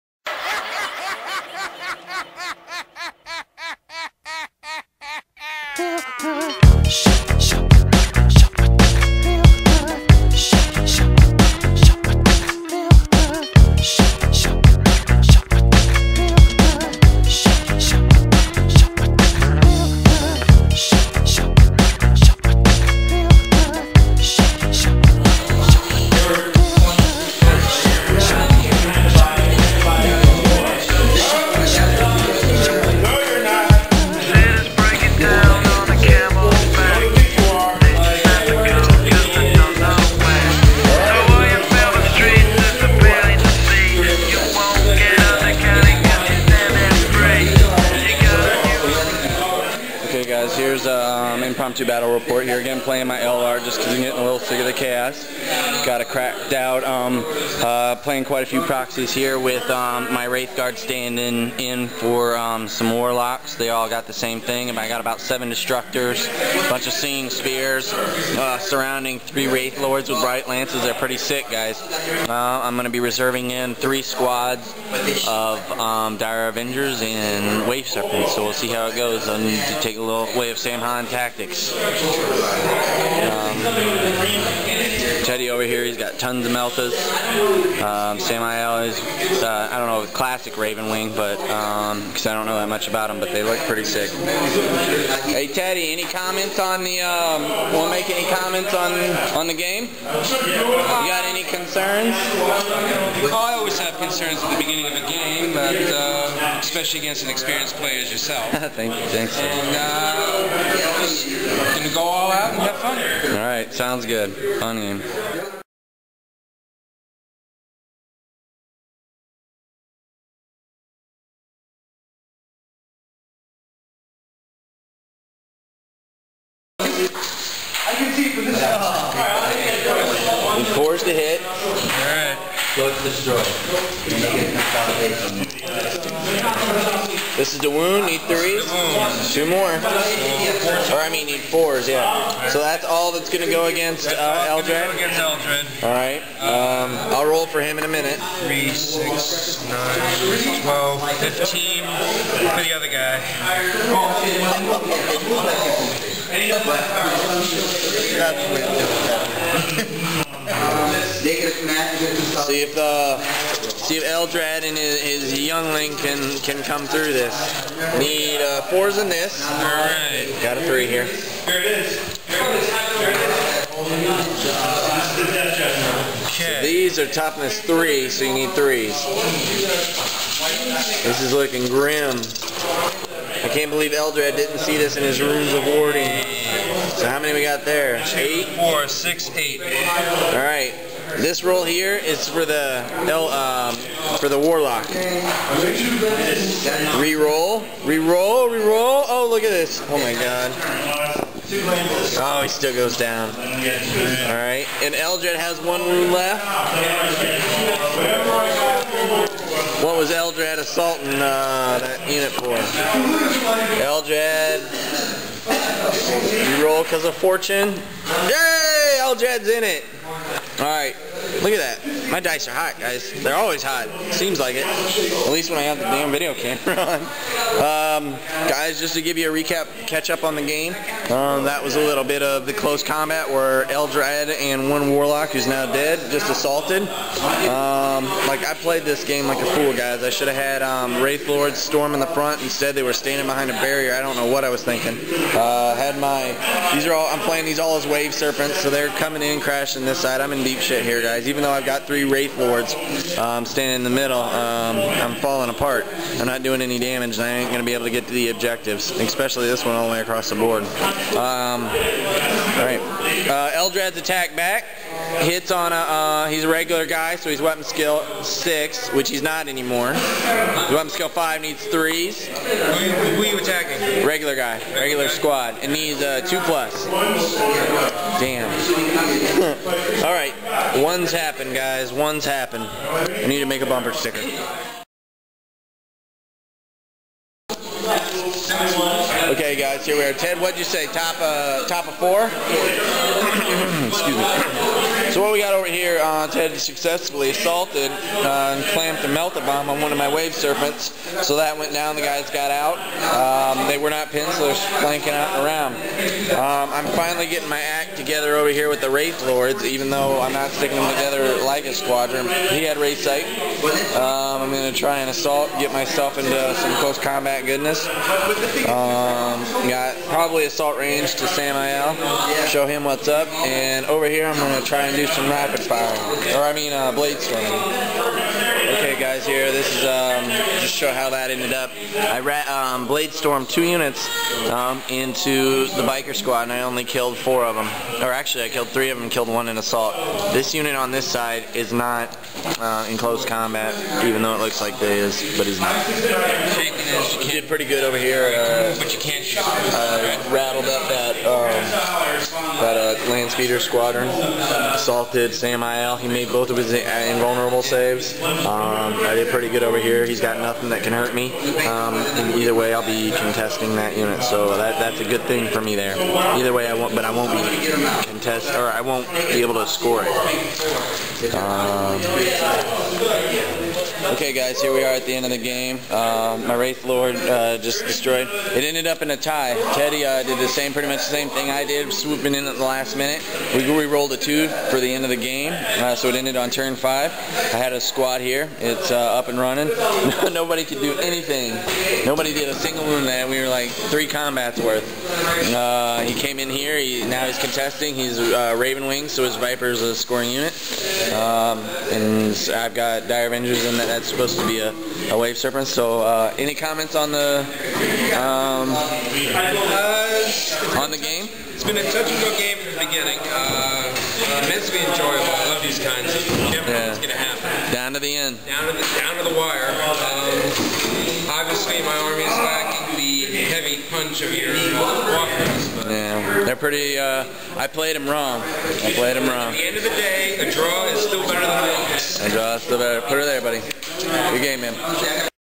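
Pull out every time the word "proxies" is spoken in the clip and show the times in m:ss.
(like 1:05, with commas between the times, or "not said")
0:58.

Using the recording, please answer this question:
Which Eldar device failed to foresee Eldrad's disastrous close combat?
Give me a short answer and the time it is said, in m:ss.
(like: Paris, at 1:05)
runes of warding, at 3:05.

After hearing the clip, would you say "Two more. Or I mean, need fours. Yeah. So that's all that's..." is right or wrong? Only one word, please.
right.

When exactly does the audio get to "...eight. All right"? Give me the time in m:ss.
3:09.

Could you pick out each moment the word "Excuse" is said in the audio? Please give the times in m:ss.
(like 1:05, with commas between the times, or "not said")
4:53.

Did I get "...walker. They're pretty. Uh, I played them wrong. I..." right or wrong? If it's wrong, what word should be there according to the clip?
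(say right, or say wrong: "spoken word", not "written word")
right.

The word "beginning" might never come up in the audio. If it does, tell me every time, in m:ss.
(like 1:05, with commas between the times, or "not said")
1:44, 6:52.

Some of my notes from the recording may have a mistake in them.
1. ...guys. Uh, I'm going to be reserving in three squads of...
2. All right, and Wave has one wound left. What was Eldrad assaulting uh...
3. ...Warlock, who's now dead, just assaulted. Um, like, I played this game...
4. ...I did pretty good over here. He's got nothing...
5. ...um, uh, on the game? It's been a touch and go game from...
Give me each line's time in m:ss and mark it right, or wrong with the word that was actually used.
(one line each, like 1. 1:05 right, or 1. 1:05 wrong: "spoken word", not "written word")
1. 1:11 right
2. 3:23 wrong: "Eldrad", not "Wave"
3. 3:54 right
4. 5:58 right
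5. 6:48 right.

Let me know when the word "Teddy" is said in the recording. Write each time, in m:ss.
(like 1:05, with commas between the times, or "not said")
1:25, 1:35, 6:19.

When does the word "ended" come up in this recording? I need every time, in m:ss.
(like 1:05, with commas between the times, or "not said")
5:31, 6:18, 6:26.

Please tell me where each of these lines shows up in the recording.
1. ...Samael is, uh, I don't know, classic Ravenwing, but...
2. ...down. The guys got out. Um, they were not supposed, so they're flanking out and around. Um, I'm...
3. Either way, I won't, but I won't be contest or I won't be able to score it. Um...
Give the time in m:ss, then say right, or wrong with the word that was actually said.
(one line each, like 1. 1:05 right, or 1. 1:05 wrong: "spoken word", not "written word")
1. 1:28 right
2. 5:01 wrong: "pinned", not "supposed"
3. 6:06 right.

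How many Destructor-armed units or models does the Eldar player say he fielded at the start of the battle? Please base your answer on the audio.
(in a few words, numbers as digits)
7.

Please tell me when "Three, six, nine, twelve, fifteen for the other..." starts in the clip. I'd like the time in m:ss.
2:28.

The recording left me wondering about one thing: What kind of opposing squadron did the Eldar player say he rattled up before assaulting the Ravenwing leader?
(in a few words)
land speeder squadron.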